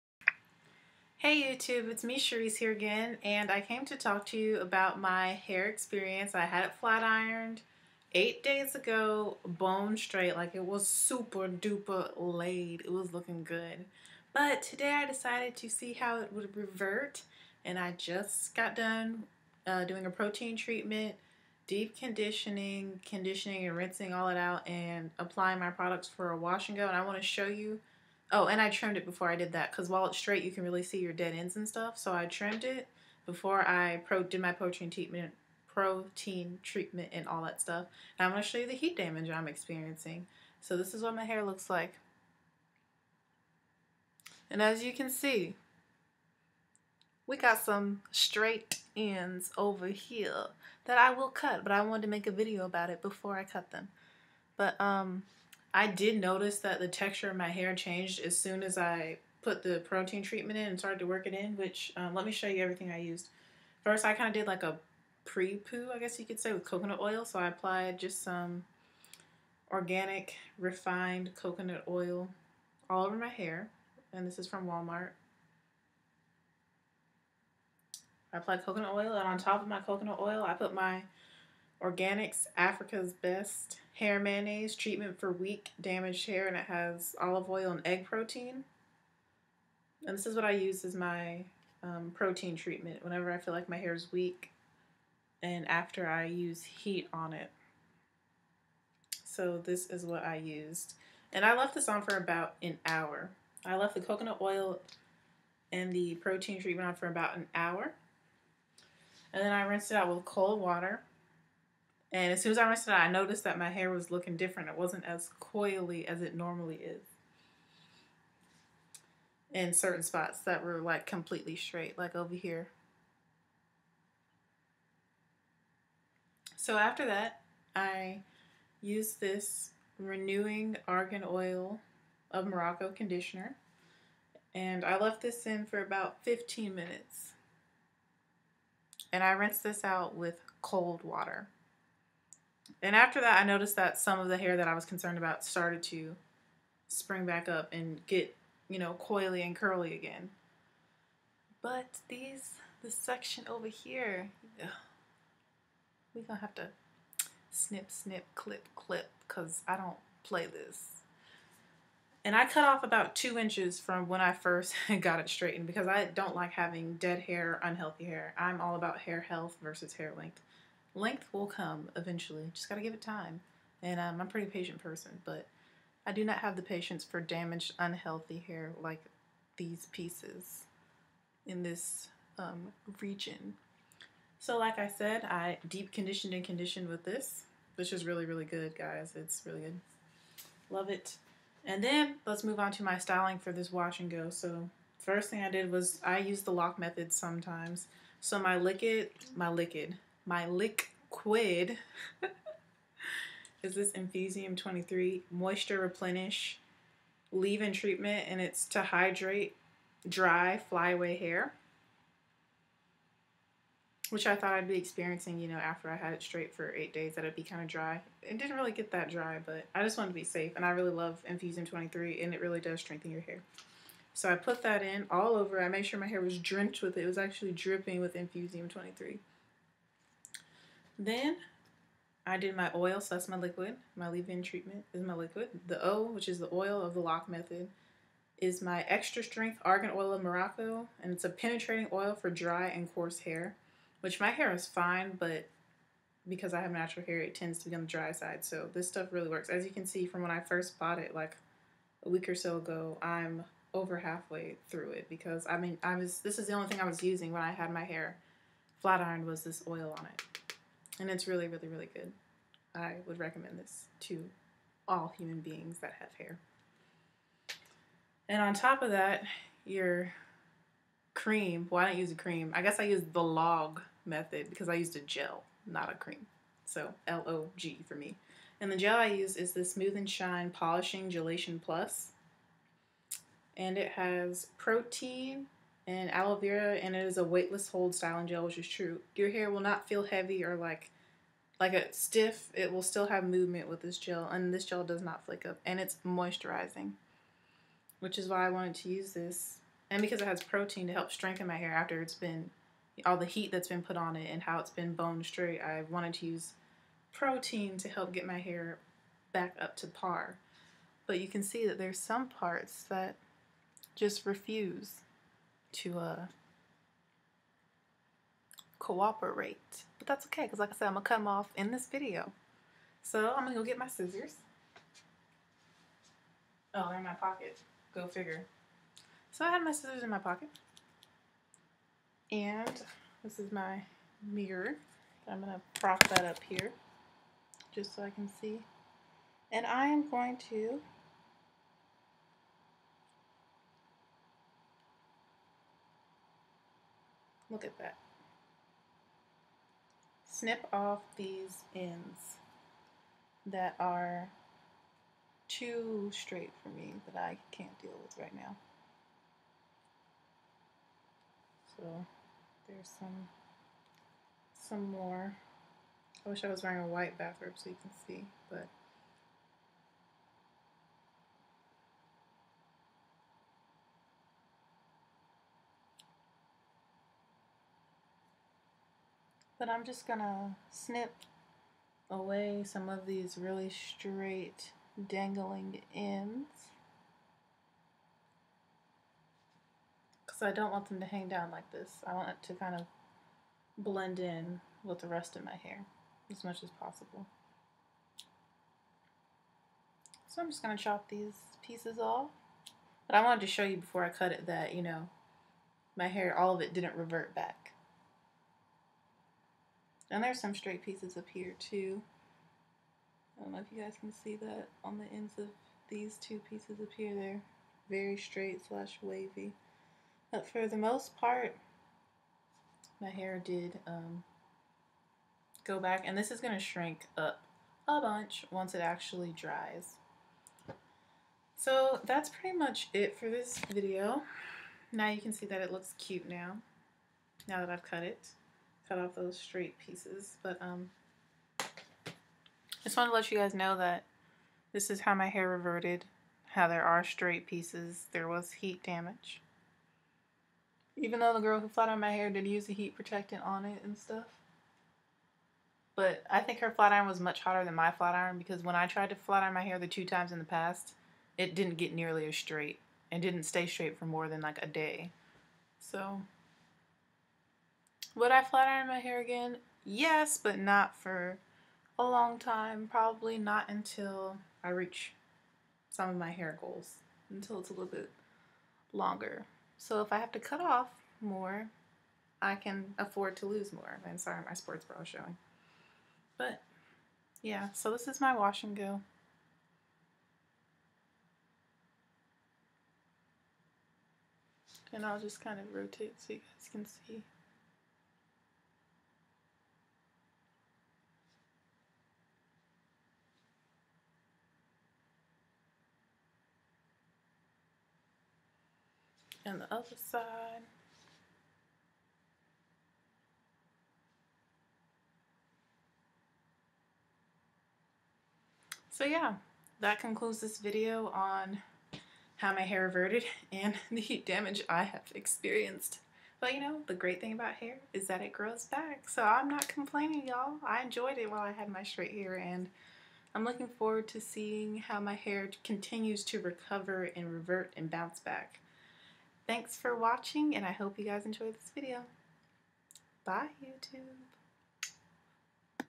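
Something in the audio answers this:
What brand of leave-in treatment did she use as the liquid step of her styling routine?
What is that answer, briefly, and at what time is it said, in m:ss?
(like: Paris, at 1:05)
Infusium 23, at 3:23.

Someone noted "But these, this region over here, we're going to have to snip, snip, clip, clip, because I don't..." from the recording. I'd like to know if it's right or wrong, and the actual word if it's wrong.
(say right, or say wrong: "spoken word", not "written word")
wrong: "section", not "region".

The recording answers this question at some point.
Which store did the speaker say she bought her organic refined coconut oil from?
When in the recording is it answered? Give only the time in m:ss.
1:14.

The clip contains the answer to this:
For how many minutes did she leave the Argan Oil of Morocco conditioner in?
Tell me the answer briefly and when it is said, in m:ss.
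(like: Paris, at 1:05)
15, at 2:16.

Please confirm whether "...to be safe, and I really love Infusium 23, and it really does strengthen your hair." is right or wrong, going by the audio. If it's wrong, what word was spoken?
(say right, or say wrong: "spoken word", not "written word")
right.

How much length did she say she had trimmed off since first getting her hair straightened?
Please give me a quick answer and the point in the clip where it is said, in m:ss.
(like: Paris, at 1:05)
about two inches, at 2:42.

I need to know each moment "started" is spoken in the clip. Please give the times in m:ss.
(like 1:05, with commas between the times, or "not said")
1:00, 2:25.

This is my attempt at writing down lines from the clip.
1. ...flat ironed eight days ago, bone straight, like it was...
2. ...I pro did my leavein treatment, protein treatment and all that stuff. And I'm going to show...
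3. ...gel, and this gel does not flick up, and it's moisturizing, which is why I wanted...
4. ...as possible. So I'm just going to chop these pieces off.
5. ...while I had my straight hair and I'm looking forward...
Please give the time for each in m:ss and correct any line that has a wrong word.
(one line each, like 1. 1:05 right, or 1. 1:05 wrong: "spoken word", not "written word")
1. 0:06 right
2. 0:33 wrong: "protein", not "leavein"
3. 4:53 right
4. 6:36 right
5. 8:51 right.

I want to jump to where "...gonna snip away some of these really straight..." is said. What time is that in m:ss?
6:20.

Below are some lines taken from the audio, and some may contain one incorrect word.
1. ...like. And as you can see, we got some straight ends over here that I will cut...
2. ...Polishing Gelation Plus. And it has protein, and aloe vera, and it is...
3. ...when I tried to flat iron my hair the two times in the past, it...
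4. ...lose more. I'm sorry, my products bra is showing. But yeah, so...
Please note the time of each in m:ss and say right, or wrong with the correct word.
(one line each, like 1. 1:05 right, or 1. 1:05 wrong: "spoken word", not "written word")
1. 0:41 right
2. 4:40 right
3. 7:38 right
4. 8:03 wrong: "sports", not "products".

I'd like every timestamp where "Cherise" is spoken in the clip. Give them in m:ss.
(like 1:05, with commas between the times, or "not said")
0:02.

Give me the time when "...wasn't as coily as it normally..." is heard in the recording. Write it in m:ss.
1:54.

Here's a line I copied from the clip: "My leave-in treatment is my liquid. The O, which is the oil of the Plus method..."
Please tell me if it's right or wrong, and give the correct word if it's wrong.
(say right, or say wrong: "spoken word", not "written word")
wrong: "LOC", not "Plus".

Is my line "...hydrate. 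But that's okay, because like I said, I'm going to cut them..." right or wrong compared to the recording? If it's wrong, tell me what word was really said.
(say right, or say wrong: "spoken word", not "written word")
wrong: "cooperate", not "hydrate".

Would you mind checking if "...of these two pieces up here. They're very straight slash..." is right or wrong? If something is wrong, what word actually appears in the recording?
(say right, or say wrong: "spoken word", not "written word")
right.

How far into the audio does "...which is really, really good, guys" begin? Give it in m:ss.
3:07.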